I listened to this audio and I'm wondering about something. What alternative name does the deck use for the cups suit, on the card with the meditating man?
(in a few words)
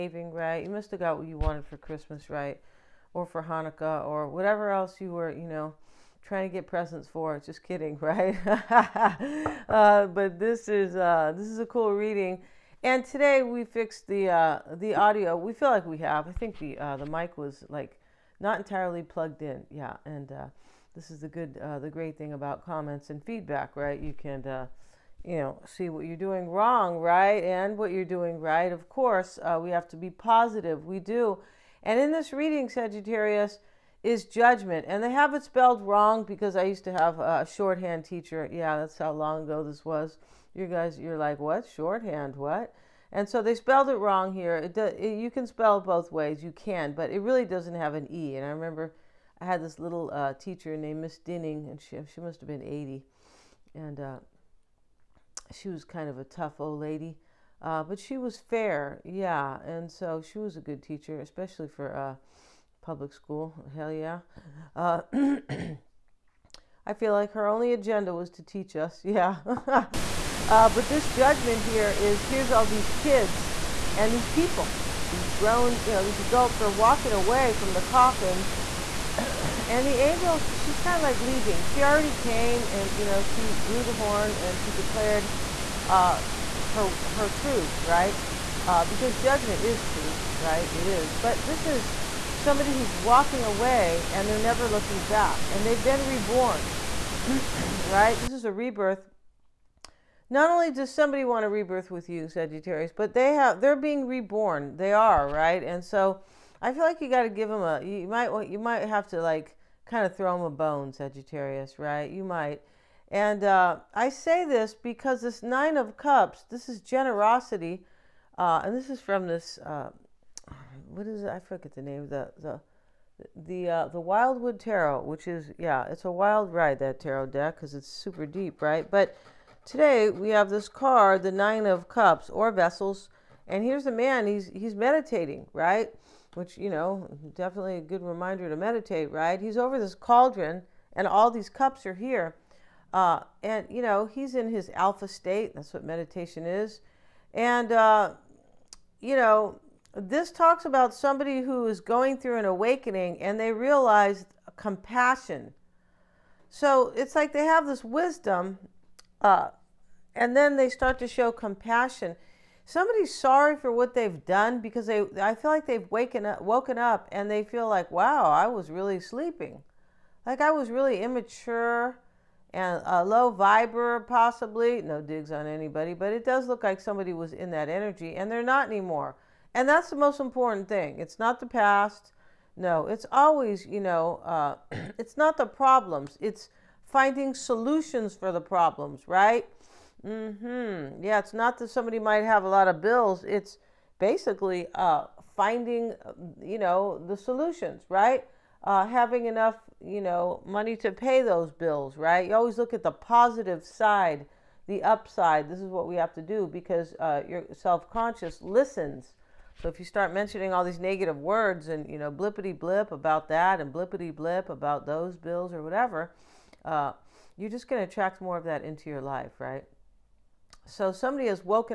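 Vessels.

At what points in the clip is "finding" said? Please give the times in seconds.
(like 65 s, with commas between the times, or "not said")
186 s, 195 s.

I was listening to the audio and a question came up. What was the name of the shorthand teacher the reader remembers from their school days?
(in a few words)
Miss Dinning.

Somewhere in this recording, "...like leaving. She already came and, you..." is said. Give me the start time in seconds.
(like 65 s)
81 s.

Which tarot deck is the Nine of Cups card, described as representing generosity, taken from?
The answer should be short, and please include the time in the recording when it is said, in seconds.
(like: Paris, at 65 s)
The Wildwood Tarot, at 123 s.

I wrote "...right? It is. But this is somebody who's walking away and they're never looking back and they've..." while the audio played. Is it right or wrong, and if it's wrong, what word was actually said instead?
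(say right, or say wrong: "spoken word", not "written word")
right.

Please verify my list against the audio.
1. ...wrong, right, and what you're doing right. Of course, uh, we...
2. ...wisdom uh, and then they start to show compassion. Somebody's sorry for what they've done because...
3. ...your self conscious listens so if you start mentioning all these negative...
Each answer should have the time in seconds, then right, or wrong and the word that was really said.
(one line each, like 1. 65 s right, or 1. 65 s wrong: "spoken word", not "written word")
1. 26 s right
2. 157 s right
3. 207 s right.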